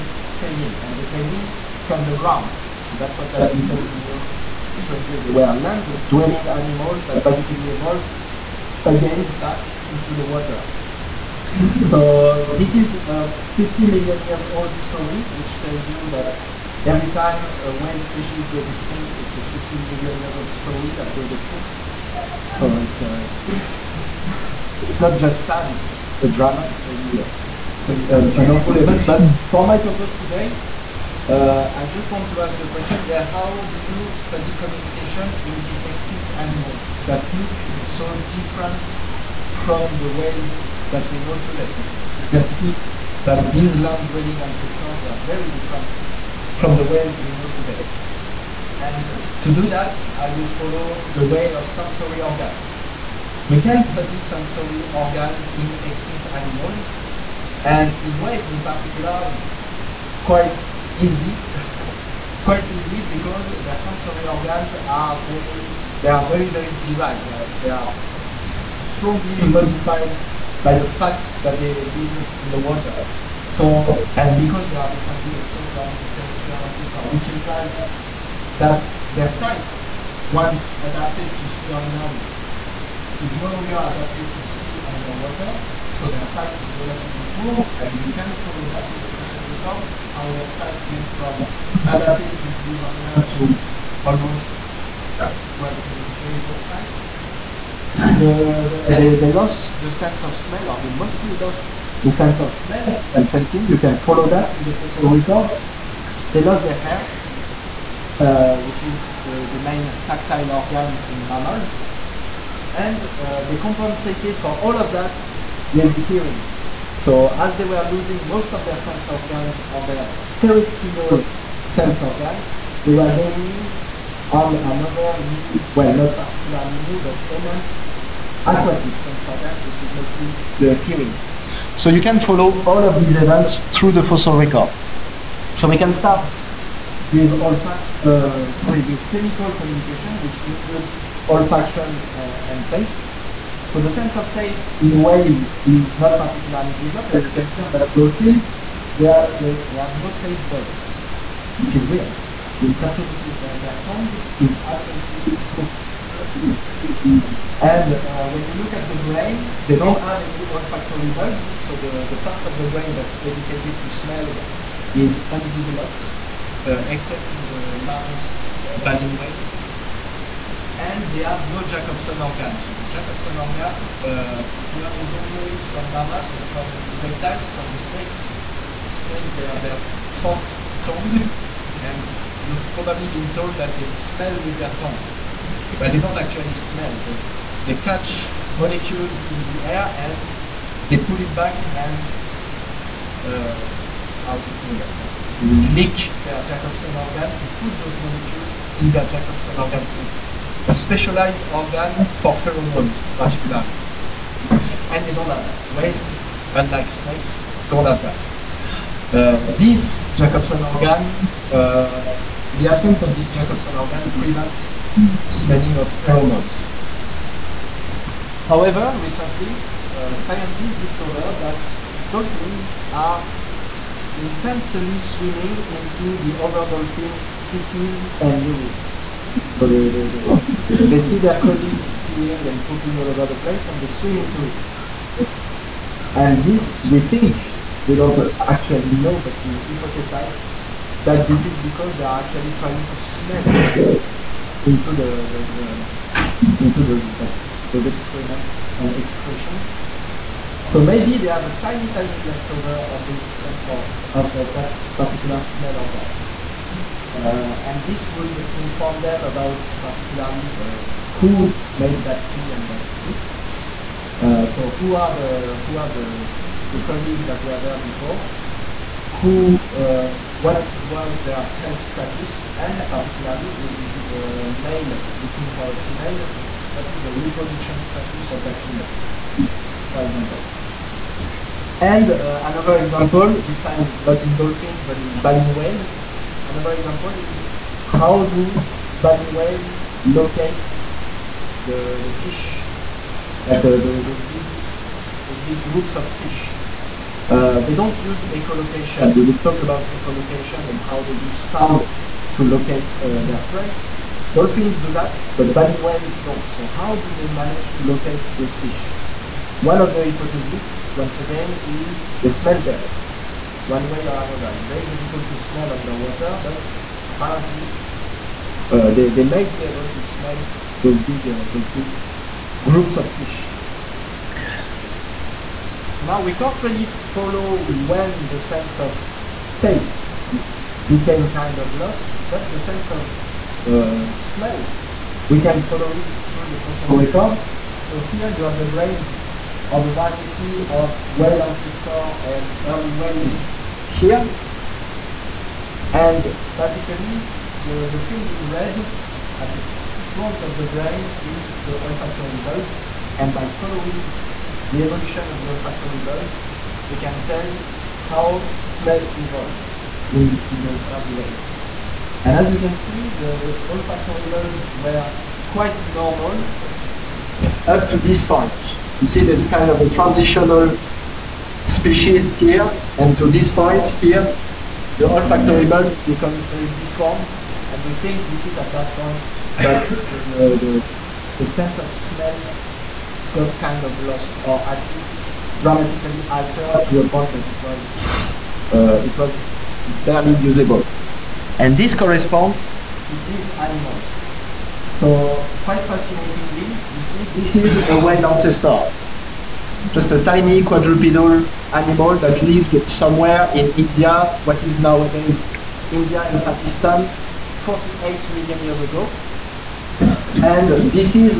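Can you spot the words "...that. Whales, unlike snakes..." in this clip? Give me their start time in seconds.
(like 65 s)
205 s.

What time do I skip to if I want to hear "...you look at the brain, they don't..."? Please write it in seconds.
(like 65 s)
158 s.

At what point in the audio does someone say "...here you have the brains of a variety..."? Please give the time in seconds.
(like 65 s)
337 s.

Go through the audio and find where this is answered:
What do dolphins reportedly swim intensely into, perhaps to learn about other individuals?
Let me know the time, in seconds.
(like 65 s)
227 s.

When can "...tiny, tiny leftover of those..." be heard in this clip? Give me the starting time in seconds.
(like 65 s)
251 s.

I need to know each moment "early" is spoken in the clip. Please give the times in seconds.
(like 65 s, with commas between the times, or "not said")
342 s, 360 s.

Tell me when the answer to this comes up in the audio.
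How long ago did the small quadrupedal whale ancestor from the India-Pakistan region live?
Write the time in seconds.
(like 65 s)
407 s.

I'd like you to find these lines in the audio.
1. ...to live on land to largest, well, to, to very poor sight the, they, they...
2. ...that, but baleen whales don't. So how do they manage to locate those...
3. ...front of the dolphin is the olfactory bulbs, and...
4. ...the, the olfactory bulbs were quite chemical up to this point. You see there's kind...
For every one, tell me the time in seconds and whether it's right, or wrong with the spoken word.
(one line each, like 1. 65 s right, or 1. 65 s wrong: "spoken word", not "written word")
1. 92 s wrong: "almost", not "largest"
2. 304 s right
3. 350 s wrong: "brain", not "dolphin"
4. 363 s wrong: "normal", not "chemical".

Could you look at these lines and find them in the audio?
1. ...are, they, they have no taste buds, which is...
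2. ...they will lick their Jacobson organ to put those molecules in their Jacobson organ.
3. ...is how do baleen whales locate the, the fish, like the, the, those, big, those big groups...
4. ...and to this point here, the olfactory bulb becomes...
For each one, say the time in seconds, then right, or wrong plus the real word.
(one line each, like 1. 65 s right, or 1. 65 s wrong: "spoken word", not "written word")
1. 149 s right
2. 195 s right
3. 287 s right
4. 372 s right.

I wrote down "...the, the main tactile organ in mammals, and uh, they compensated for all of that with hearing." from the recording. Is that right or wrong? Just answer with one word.
right.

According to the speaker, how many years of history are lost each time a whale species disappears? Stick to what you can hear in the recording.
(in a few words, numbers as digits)
15 million years.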